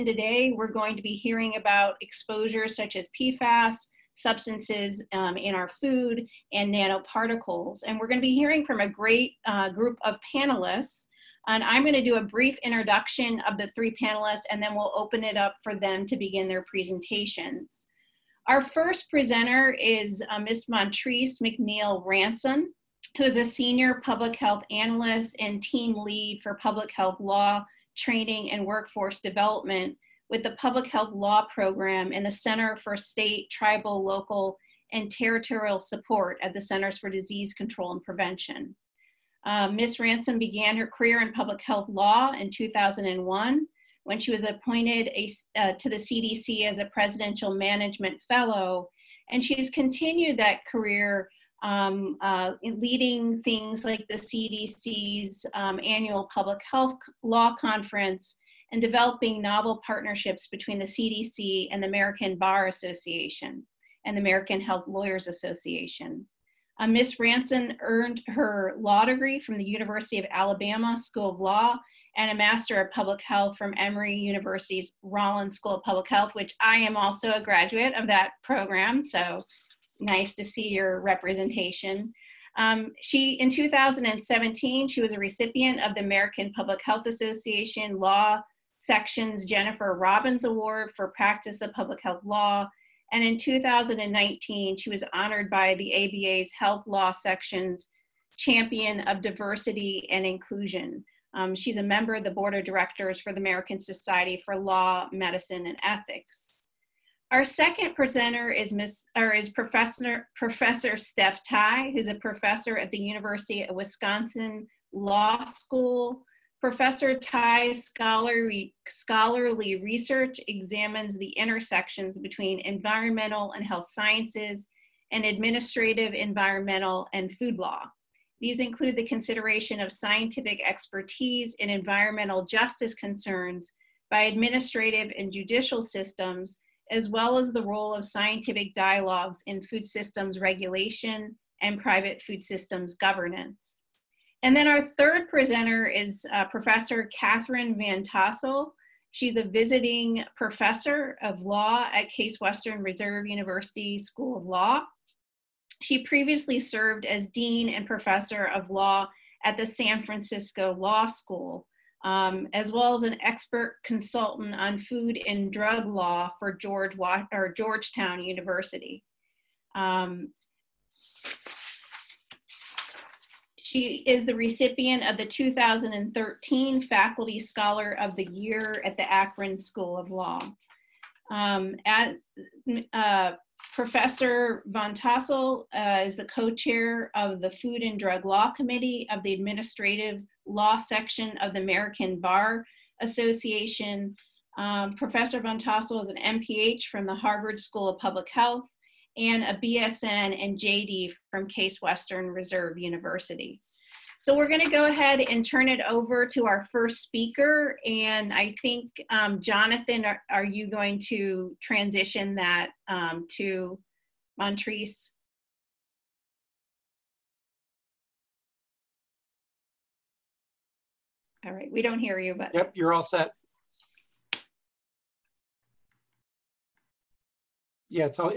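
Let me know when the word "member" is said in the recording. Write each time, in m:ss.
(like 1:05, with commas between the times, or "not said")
1:41.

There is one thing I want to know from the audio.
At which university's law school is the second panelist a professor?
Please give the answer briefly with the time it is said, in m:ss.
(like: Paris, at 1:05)
University of Wisconsin, at 1:52.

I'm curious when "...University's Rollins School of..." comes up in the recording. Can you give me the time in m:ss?
1:14.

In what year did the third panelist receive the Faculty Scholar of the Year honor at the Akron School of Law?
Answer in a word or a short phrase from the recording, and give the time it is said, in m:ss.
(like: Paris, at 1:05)
2013, at 2:55.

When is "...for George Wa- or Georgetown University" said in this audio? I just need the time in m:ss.
2:46.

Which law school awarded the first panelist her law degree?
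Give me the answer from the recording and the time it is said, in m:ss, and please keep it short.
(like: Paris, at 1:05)
University of Alabama School of Law, at 1:09.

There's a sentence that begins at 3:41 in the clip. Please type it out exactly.
All right, we don't hear you, but.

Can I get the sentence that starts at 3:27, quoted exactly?
And I think, um, Jonathan, are, are, you going to transition that um, to Montrece?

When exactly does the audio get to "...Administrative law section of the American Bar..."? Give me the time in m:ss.
3:09.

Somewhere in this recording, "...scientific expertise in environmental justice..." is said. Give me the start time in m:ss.
2:09.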